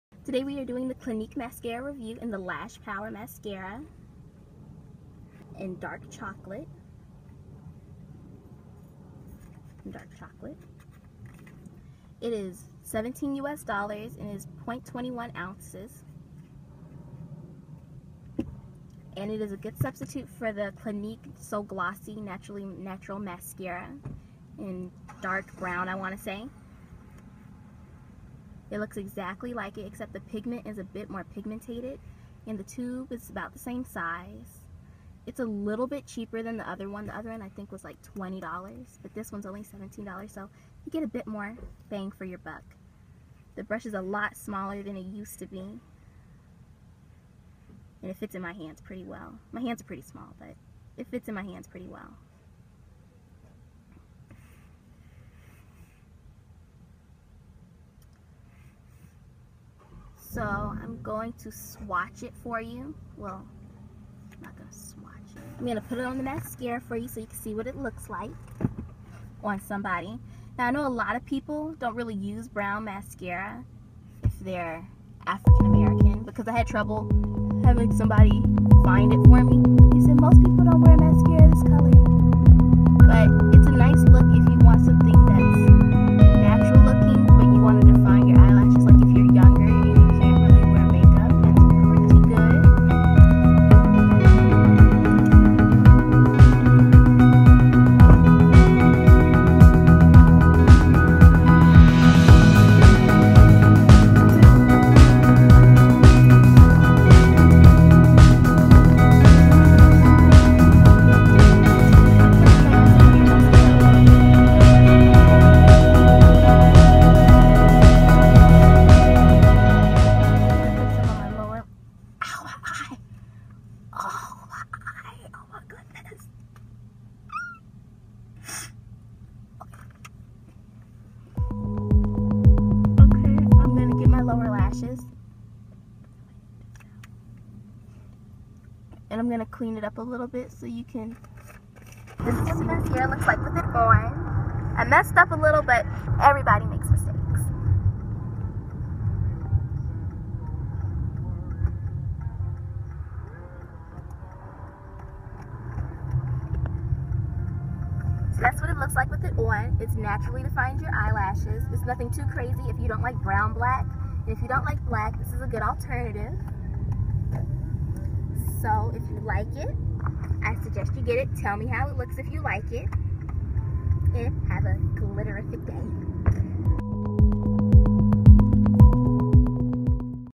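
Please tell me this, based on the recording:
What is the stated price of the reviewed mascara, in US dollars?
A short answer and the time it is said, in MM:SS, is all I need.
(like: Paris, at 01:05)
$17, at 00:12.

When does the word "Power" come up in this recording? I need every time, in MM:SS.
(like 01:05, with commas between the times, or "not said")
00:02.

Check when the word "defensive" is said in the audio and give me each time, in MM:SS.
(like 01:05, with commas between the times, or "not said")
not said.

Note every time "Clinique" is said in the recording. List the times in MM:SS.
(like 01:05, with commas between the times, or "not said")
00:00, 00:20.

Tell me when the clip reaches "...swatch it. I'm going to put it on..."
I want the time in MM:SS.
01:04.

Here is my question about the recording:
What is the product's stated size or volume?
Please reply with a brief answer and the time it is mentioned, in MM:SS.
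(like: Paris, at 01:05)
0.21 ounces, at 00:14.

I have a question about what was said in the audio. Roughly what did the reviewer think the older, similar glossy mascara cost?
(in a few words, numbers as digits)
$20.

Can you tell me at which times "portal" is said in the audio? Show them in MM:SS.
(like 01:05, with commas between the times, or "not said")
not said.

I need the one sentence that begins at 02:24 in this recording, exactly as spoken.
I messed up a little, but everybody makes mistakes.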